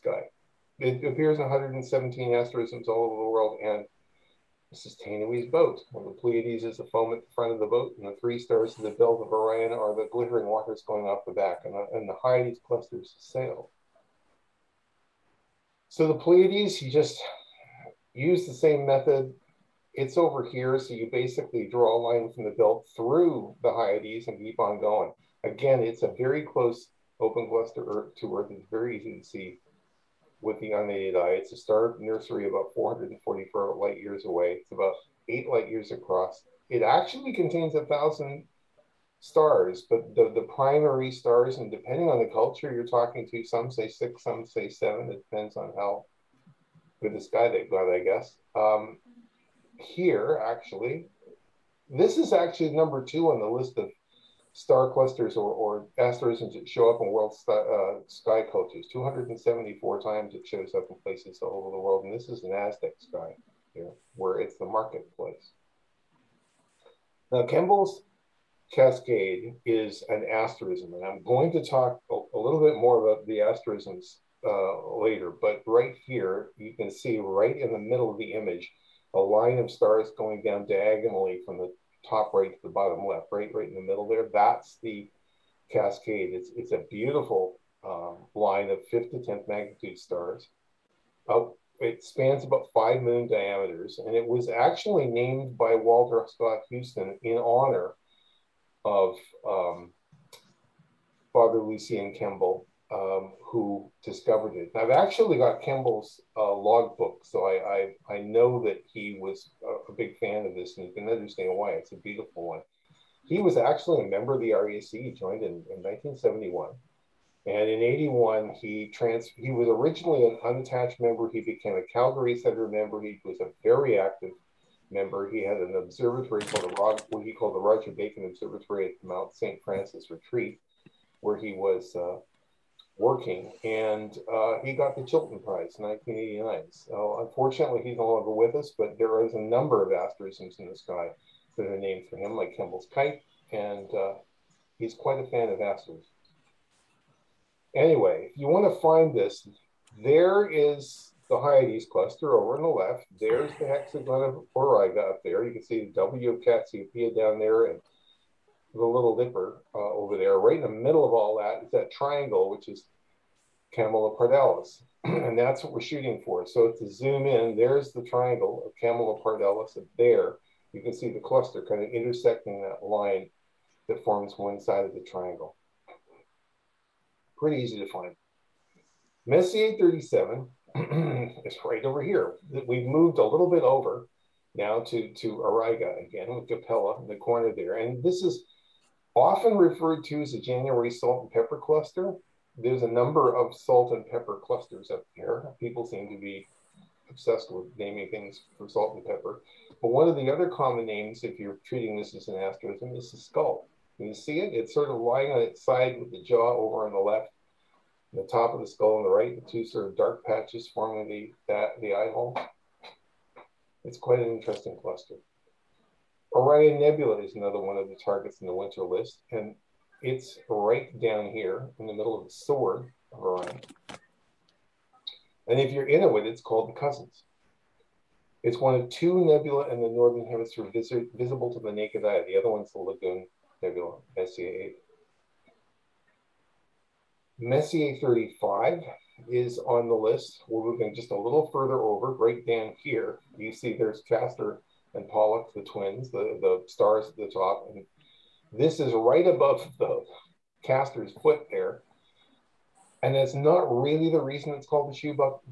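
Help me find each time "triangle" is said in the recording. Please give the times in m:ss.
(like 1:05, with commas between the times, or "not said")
2:41, 2:48, 2:55.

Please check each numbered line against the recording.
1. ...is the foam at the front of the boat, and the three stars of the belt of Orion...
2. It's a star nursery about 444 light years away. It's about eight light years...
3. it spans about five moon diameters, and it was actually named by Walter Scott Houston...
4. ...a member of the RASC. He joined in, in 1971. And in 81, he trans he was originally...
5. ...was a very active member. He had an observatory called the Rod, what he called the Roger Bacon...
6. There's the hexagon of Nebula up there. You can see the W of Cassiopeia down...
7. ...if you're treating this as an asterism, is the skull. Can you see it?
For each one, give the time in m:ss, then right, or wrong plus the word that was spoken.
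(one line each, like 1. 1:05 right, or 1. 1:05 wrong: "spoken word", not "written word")
1. 0:06 right
2. 0:31 right
3. 1:31 right
4. 1:54 right
5. 2:03 right
6. 2:33 wrong: "Auriga", not "Nebula"
7. 3:21 right.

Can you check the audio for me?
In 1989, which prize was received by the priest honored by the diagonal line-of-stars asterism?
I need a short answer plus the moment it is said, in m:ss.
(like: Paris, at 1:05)
Chilton Prize, at 2:15.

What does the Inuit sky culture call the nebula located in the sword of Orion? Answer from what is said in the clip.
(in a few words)
The Cousins.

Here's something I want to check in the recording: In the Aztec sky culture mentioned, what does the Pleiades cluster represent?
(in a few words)
The marketplace.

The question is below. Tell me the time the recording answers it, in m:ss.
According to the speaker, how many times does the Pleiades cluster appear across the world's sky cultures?
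0:58.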